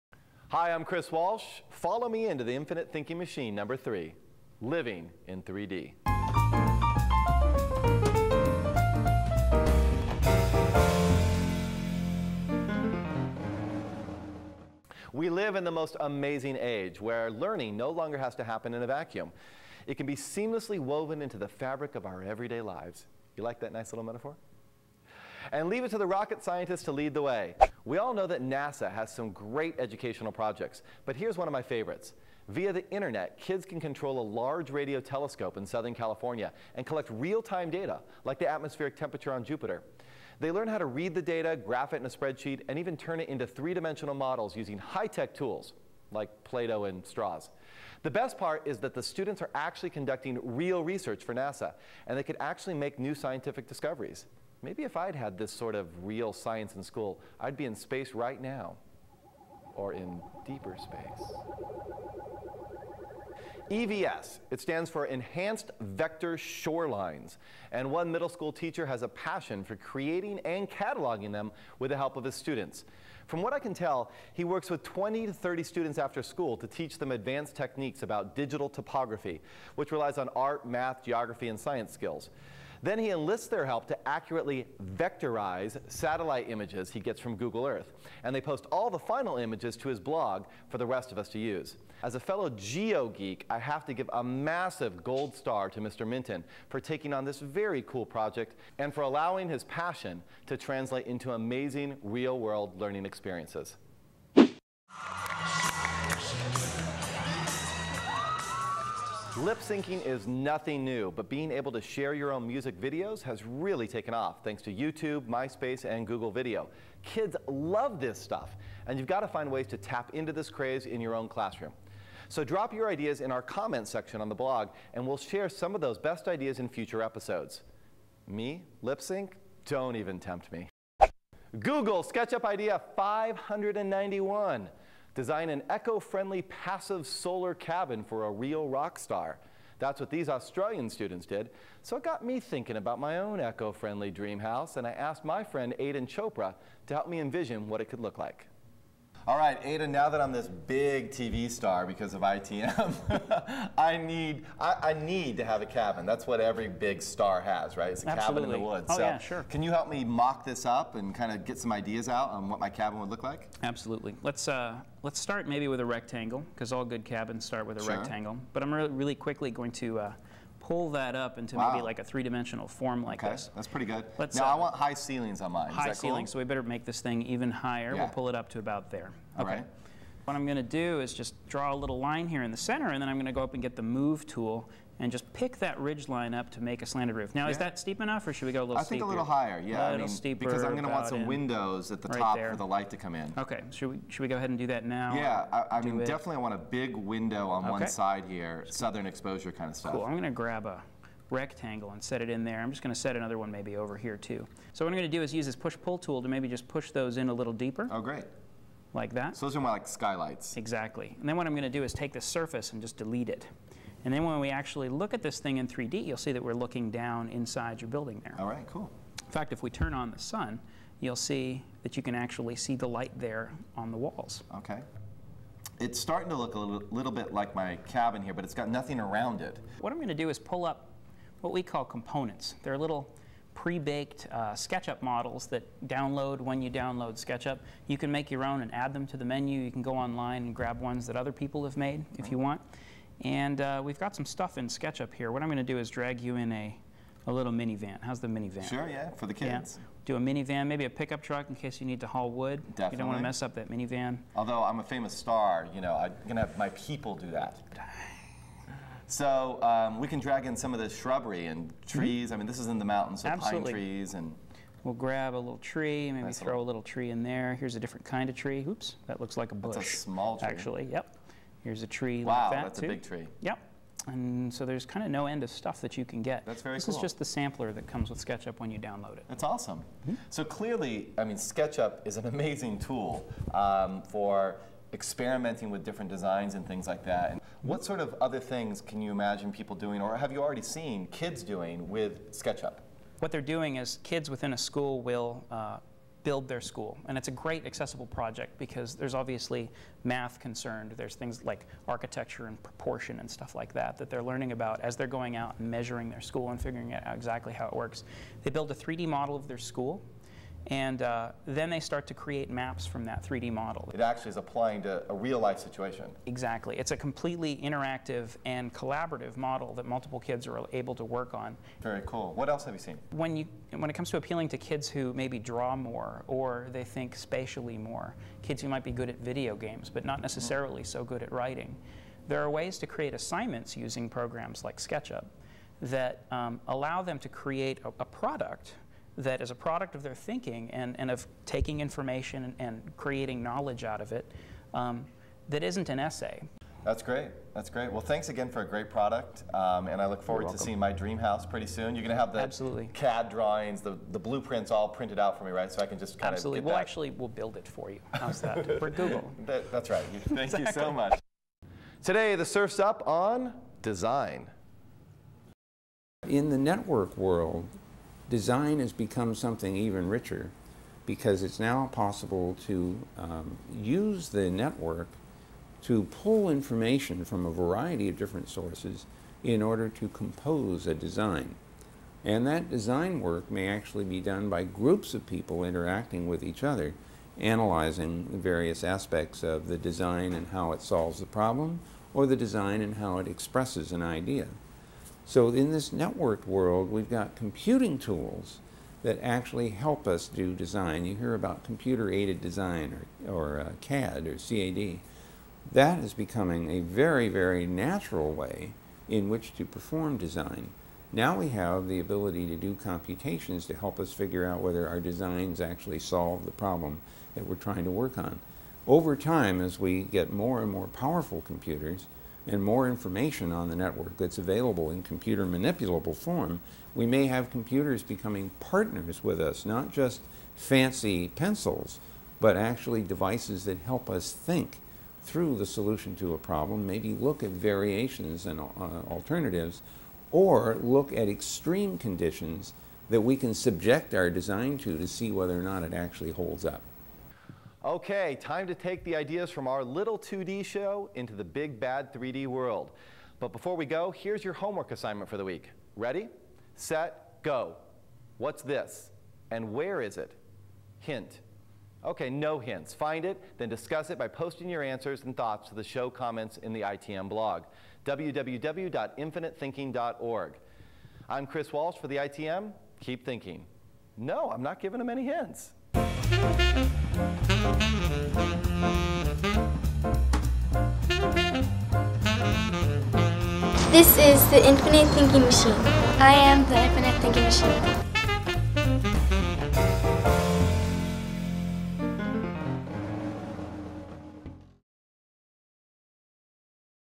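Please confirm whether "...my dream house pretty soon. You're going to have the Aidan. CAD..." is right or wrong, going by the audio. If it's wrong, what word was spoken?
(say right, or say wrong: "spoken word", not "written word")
wrong: "Absolutely", not "Aidan".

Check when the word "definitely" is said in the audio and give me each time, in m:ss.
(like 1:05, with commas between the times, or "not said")
3:16, 4:12.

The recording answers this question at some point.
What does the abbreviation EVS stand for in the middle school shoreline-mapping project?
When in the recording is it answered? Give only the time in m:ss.
1:05.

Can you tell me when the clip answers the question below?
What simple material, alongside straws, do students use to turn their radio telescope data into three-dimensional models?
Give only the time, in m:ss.
0:46.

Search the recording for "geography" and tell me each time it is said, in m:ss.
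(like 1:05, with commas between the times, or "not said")
1:21.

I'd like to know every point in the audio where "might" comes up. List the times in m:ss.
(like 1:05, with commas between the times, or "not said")
5:28.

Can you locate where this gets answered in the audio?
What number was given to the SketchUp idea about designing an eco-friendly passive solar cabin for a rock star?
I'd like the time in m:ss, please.
2:12.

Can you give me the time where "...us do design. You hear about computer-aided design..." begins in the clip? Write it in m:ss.
6:40.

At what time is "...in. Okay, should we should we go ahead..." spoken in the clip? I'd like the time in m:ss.
3:13.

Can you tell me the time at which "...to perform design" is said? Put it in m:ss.
6:49.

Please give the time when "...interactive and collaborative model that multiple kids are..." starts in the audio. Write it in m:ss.
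5:17.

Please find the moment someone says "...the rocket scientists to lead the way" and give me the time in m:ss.
0:25.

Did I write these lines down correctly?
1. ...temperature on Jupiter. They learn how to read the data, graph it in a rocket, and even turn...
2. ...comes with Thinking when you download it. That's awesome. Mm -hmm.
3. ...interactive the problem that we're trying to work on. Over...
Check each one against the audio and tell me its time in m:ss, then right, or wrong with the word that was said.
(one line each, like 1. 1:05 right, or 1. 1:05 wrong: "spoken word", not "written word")
1. 0:38 wrong: "spreadsheet", not "rocket"
2. 4:37 wrong: "SketchUp", not "Thinking"
3. 6:55 wrong: "solve", not "interactive".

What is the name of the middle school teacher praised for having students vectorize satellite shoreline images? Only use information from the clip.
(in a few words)
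Mr. Minton.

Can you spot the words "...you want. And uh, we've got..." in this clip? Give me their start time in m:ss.
4:02.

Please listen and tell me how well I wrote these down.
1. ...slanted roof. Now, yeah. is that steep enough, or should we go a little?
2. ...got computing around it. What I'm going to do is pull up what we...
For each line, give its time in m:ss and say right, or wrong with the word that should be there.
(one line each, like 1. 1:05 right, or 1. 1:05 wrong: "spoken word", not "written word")
1. 3:06 right
2. 3:48 wrong: "nothing", not "computing".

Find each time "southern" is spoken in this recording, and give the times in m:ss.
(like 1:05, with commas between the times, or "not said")
0:35, 3:18.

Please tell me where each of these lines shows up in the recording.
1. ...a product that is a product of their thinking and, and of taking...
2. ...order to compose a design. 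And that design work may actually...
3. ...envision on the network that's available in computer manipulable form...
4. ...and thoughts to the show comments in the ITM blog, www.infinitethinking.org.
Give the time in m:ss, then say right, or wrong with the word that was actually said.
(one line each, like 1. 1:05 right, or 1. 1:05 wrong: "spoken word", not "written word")
1. 5:37 right
2. 6:19 right
3. 7:02 wrong: "information", not "envision"
4. 7:45 right.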